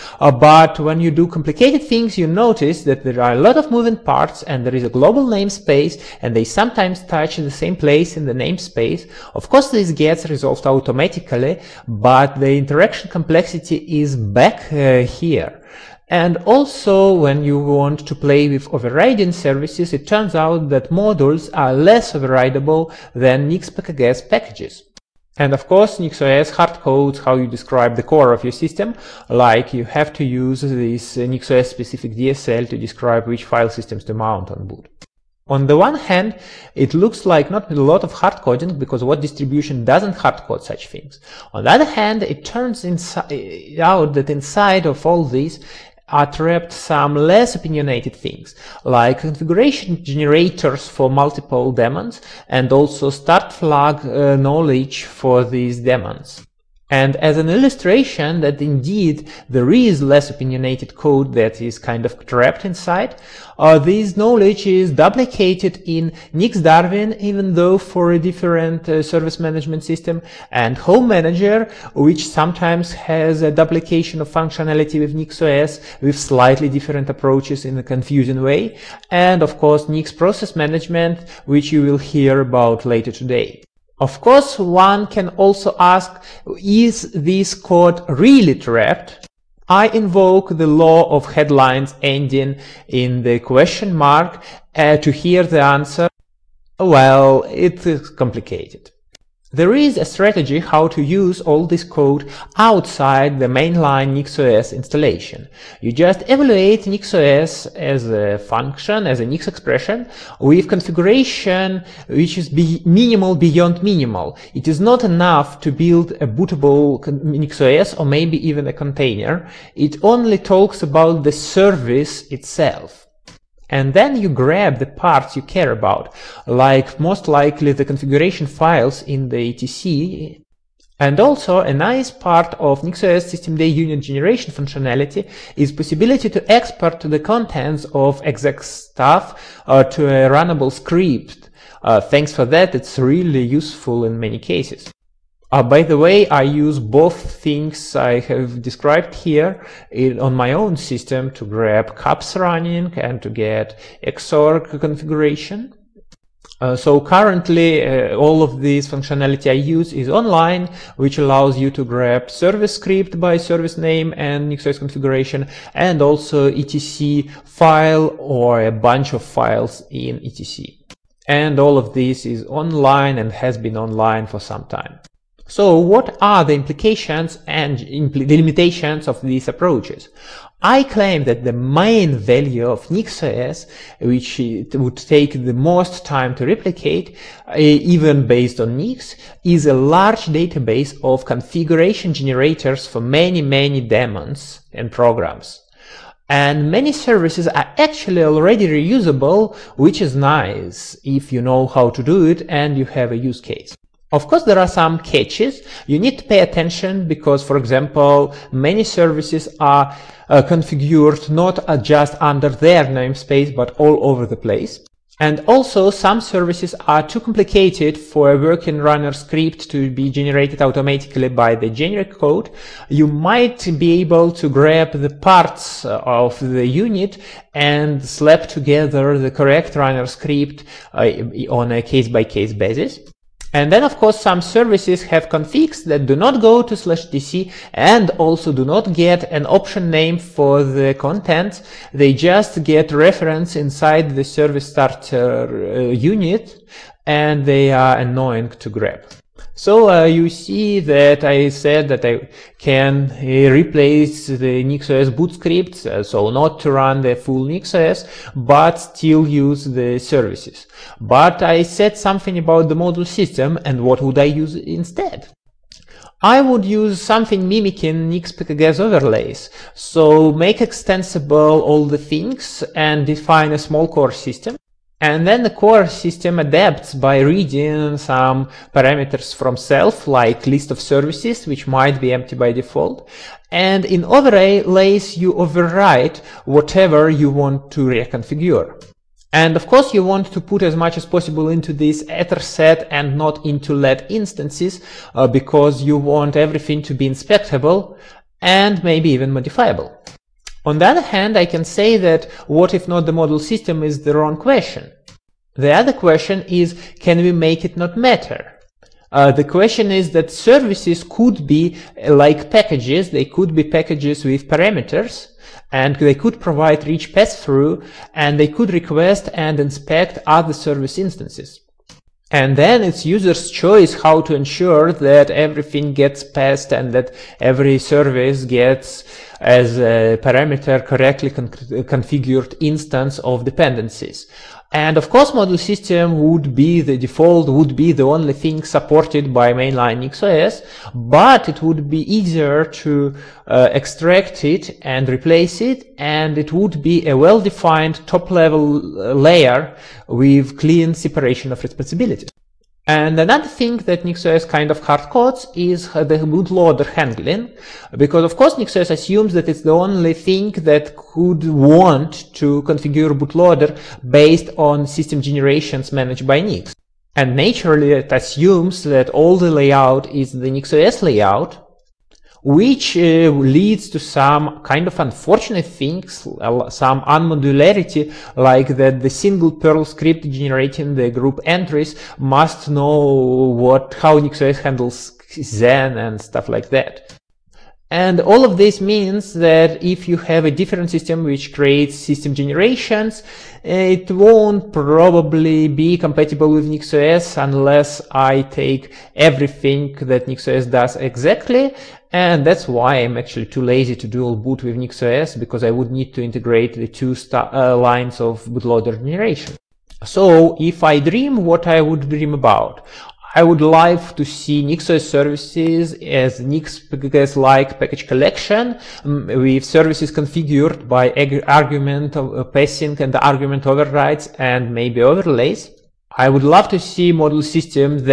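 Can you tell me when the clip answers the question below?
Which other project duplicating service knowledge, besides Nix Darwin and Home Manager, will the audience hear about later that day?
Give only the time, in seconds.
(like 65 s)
79 s.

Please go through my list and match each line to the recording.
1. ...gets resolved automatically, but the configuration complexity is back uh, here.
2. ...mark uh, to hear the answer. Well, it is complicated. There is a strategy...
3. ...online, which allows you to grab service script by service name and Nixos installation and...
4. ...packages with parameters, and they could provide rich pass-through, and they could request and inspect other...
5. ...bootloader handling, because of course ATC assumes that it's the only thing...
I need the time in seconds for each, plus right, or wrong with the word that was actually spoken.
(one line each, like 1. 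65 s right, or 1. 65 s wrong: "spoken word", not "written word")
1. 9 s wrong: "interaction", not "configuration"
2. 93 s right
3. 160 s wrong: "configuration", not "installation"
4. 313 s right
5. 356 s wrong: "NixOS", not "ATC".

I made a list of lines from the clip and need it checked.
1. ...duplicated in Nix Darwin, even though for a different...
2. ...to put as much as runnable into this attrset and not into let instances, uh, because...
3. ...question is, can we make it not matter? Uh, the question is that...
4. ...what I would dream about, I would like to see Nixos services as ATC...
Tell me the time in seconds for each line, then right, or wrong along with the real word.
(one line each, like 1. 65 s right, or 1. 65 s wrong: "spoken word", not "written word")
1. 64 s right
2. 290 s wrong: "possible", not "runnable"
3. 305 s right
4. 411 s wrong: "Nix", not "ATC".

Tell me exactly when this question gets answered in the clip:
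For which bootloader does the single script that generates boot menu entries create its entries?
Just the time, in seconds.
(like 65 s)
381 s.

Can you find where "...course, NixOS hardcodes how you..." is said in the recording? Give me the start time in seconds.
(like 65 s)
25 s.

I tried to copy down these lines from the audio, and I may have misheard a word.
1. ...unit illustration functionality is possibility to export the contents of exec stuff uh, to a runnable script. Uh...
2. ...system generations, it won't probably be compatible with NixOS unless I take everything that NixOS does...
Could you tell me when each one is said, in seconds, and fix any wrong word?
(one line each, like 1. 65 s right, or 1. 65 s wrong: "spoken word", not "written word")
1. 133 s wrong: "generation", not "illustration"
2. 391 s right.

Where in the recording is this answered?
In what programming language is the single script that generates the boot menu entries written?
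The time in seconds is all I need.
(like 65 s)
379 s.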